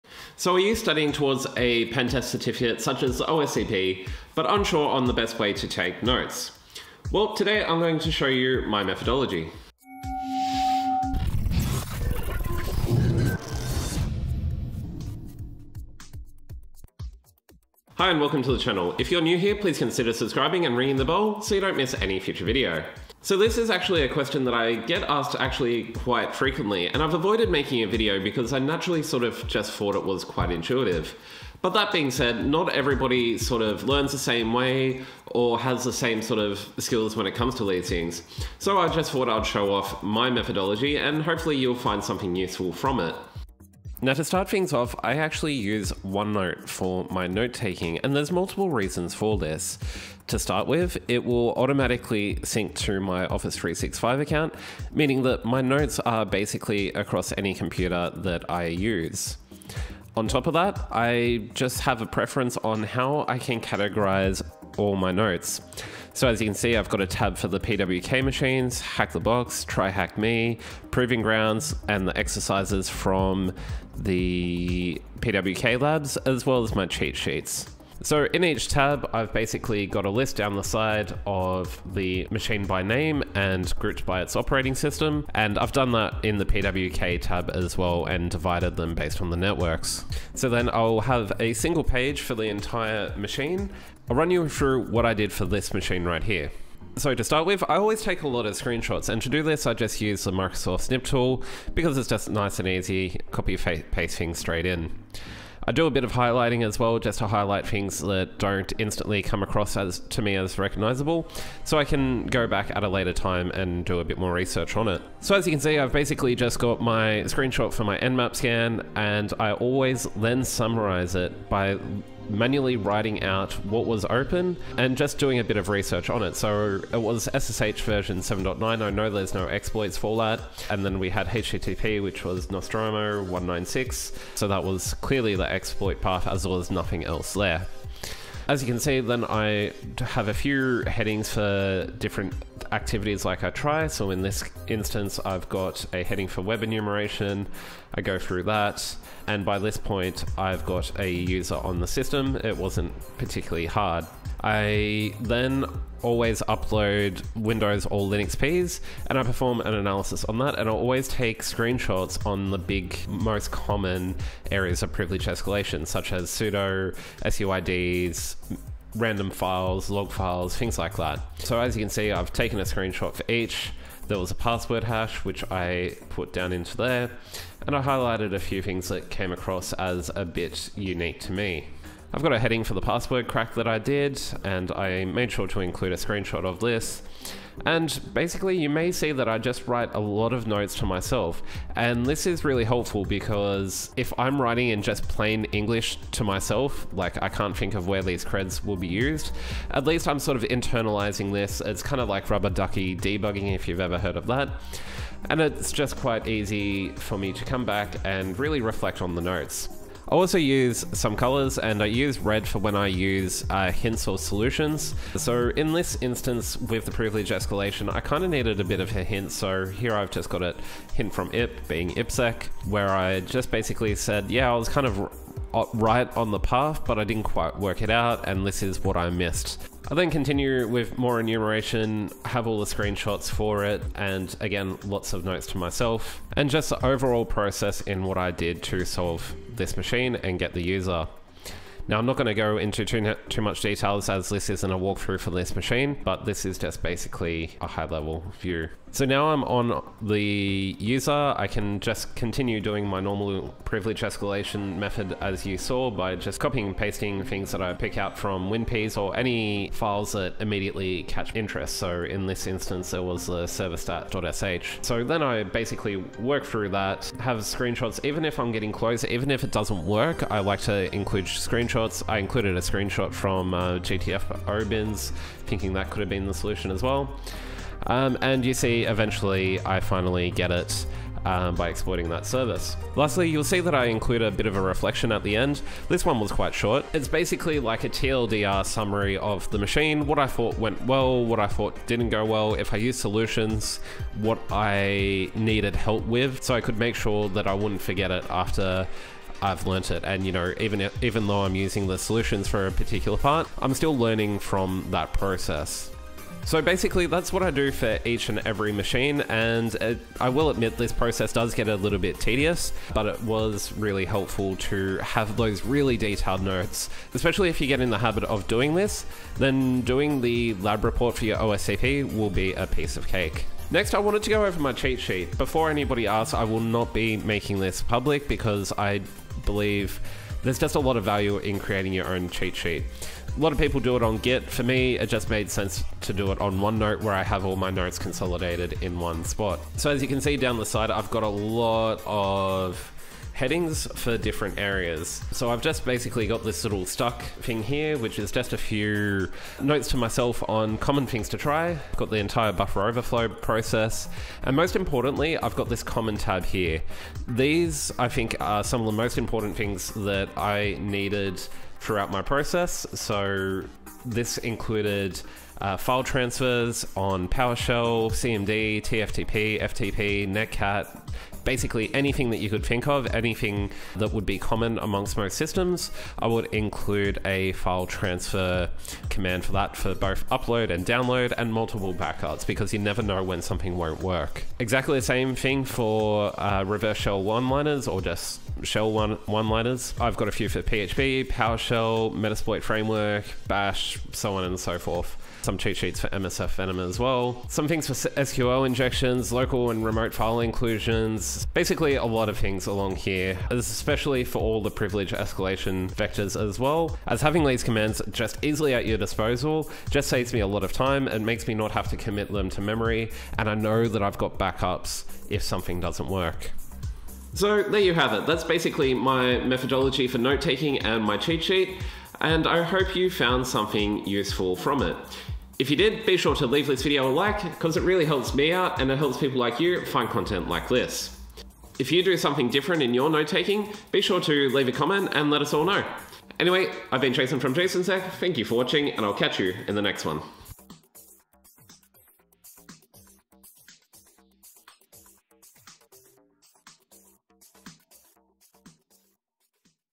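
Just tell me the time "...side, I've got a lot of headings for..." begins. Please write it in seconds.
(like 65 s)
340 s.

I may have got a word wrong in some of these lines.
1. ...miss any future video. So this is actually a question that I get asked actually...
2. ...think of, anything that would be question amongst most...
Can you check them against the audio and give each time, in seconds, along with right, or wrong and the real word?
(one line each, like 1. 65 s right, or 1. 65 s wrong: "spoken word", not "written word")
1. 21 s right
2. 372 s wrong: "common", not "question".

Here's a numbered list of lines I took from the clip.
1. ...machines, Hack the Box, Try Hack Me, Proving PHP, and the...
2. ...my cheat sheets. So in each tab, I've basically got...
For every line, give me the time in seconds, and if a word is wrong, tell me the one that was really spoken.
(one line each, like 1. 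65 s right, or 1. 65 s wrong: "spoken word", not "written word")
1. 68 s wrong: "Grounds", not "PHP"
2. 76 s right.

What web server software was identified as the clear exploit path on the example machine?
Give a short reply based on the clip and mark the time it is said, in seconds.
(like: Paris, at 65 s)
Nostromo, at 132 s.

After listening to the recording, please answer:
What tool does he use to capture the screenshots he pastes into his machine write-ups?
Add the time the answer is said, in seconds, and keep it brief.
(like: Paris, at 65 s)
Microsoft Snip tool, at 100 s.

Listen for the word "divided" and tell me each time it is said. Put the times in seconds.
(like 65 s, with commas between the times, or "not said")
88 s.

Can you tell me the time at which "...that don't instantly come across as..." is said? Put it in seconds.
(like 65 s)
107 s.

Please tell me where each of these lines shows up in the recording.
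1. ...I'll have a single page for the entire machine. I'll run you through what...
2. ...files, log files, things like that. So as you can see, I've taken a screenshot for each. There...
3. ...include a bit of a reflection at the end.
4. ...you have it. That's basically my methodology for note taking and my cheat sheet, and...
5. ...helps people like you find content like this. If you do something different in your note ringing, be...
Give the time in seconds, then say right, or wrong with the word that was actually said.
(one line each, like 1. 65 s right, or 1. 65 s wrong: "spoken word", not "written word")
1. 90 s right
2. 169 s right
3. 283 s right
4. 417 s right
5. 428 s wrong: "taking", not "ringing".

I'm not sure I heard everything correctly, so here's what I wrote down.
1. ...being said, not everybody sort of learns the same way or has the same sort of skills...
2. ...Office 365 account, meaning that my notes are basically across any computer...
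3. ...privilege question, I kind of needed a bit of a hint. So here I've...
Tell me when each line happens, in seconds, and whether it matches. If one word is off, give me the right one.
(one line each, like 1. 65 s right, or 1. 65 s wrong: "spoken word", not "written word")
1. 31 s right
2. 53 s right
3. 216 s wrong: "escalation", not "question".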